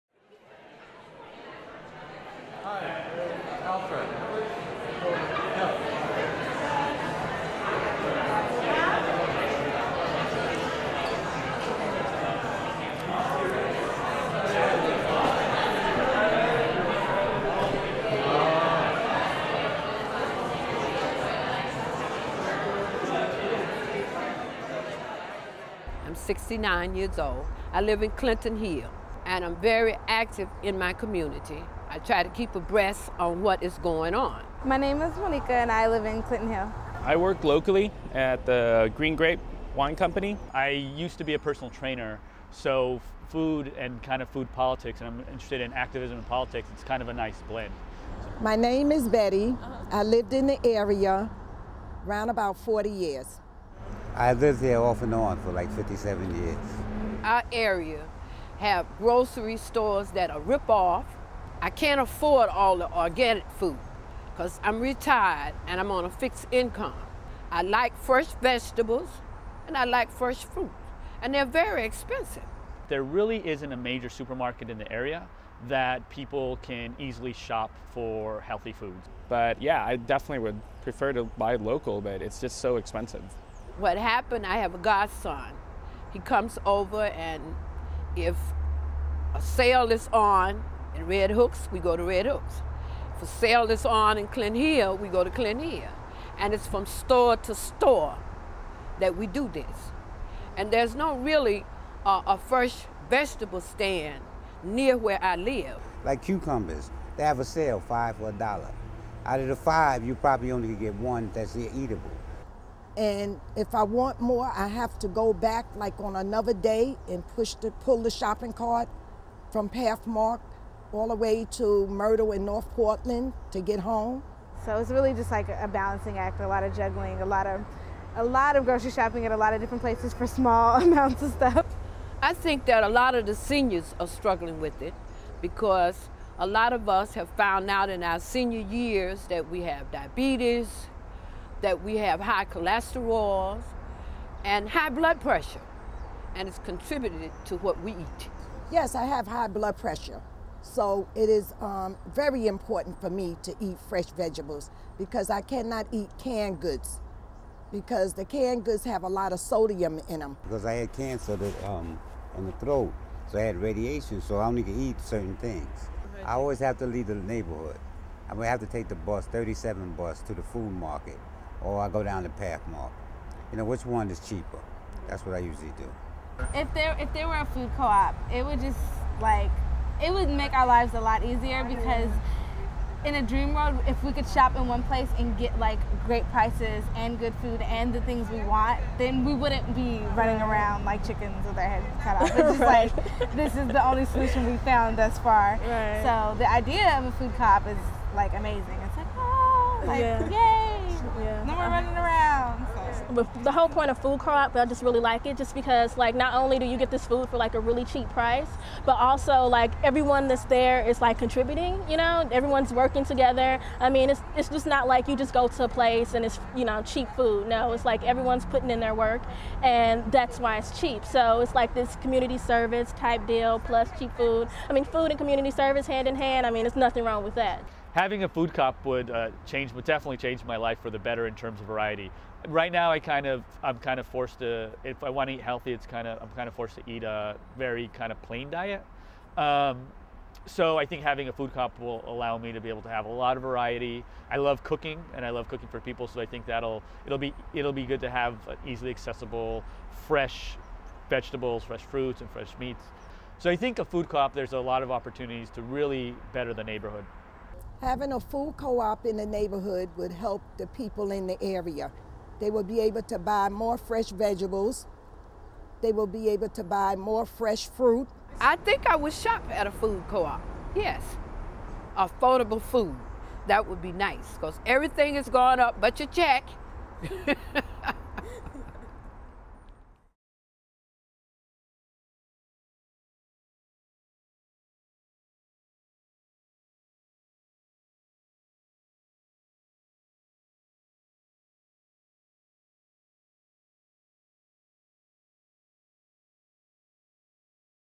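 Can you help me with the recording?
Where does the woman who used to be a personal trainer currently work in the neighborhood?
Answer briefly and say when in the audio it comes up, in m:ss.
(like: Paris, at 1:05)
Green Grape Wine Company, at 0:38.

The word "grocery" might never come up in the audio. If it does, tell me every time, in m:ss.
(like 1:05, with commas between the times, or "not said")
0:58, 2:08.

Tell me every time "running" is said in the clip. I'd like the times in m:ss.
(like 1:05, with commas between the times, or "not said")
3:10, 3:21.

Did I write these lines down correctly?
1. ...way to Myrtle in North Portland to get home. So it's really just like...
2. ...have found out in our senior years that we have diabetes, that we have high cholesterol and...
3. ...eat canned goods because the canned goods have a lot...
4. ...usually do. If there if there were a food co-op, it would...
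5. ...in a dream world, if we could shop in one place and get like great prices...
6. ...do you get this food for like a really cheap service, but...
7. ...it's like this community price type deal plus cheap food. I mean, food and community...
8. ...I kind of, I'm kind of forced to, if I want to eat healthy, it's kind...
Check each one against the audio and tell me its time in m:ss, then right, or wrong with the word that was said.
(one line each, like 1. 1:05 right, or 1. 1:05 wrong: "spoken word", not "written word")
1. 2:01 right
2. 2:17 right
3. 2:35 right
4. 2:55 right
5. 3:03 right
6. 3:26 wrong: "price", not "service"
7. 3:41 wrong: "service", not "price"
8. 3:52 right.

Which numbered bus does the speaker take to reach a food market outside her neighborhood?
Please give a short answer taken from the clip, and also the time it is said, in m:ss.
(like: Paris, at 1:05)
37, at 2:49.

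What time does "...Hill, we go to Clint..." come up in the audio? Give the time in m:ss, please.
1:34.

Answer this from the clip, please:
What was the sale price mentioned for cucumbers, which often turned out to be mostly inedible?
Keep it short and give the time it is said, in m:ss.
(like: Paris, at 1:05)
5 for $1, at 1:47.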